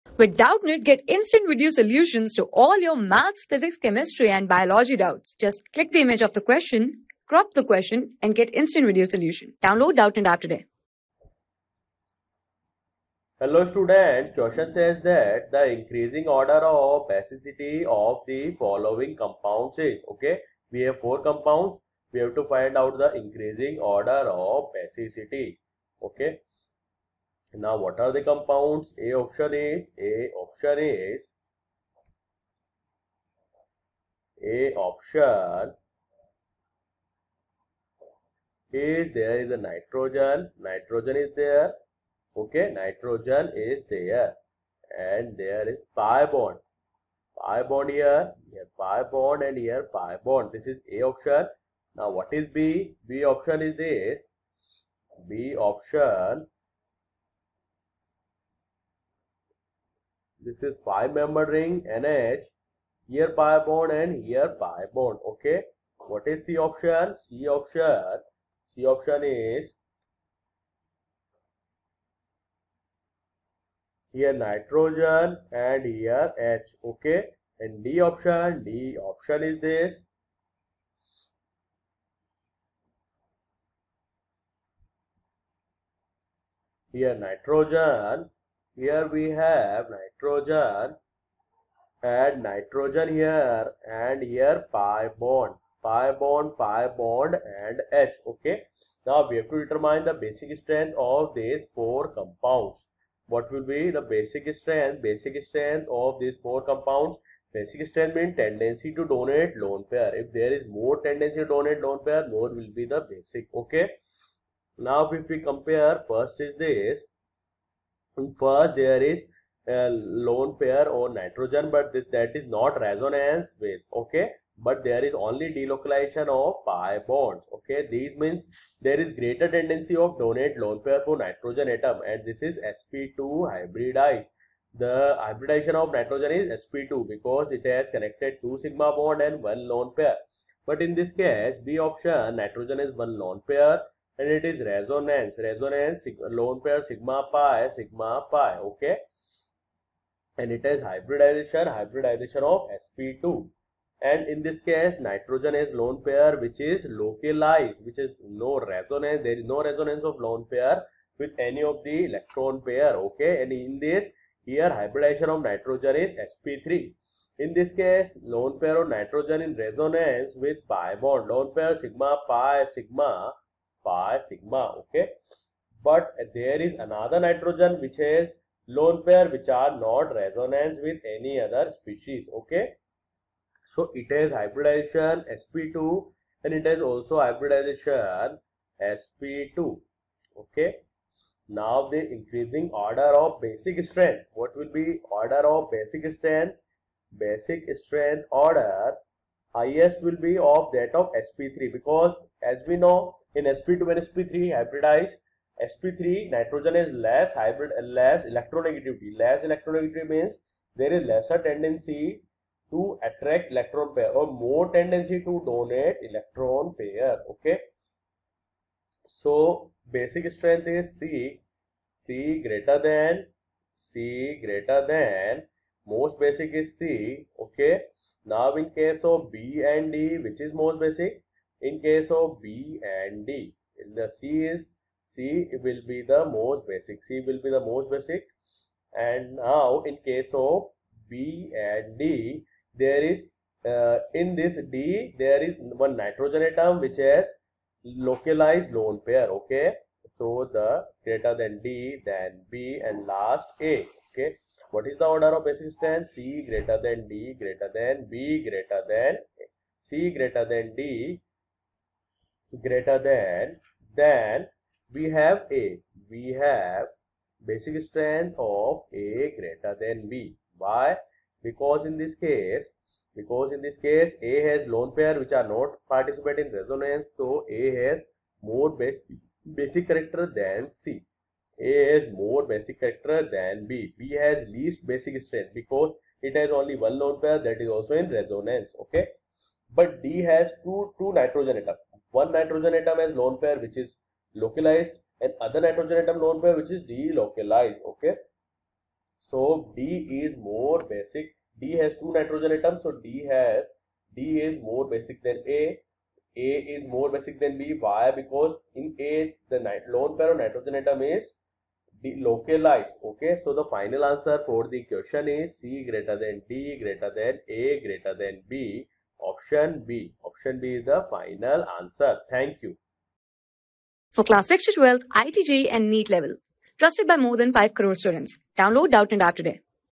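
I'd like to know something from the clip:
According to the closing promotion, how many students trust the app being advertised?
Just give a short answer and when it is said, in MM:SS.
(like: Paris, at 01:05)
5 crore, at 05:27.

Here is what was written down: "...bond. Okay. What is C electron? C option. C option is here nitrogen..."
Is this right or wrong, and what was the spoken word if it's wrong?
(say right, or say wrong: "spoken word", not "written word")
wrong: "option", not "electron".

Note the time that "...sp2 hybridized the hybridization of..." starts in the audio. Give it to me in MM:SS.
02:12.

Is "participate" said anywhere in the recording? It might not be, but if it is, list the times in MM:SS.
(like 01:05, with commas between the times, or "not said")
04:35.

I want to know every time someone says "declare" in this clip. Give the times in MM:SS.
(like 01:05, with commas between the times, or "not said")
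not said.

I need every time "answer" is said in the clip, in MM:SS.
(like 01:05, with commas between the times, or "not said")
05:14, 05:21.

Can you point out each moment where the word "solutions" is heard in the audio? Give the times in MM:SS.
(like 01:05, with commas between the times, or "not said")
00:01, 00:09.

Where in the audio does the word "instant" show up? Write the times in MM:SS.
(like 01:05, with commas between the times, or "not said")
00:01, 00:08.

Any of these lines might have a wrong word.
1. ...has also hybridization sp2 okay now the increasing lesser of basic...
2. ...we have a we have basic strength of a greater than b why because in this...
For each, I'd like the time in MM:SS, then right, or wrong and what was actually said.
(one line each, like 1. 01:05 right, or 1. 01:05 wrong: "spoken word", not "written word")
1. 03:06 wrong: "order", not "lesser"
2. 04:24 right.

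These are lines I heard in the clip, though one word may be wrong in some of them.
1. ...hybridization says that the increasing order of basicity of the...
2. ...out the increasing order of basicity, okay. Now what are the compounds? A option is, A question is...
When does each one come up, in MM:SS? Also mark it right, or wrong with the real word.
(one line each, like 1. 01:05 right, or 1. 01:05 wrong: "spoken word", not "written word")
1. 00:14 wrong: "question", not "hybridization"
2. 00:22 wrong: "option", not "question".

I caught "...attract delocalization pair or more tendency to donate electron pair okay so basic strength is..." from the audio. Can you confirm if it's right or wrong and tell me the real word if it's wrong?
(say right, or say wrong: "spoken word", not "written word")
wrong: "electron", not "delocalization".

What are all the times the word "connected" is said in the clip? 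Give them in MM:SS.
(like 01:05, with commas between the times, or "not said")
02:17.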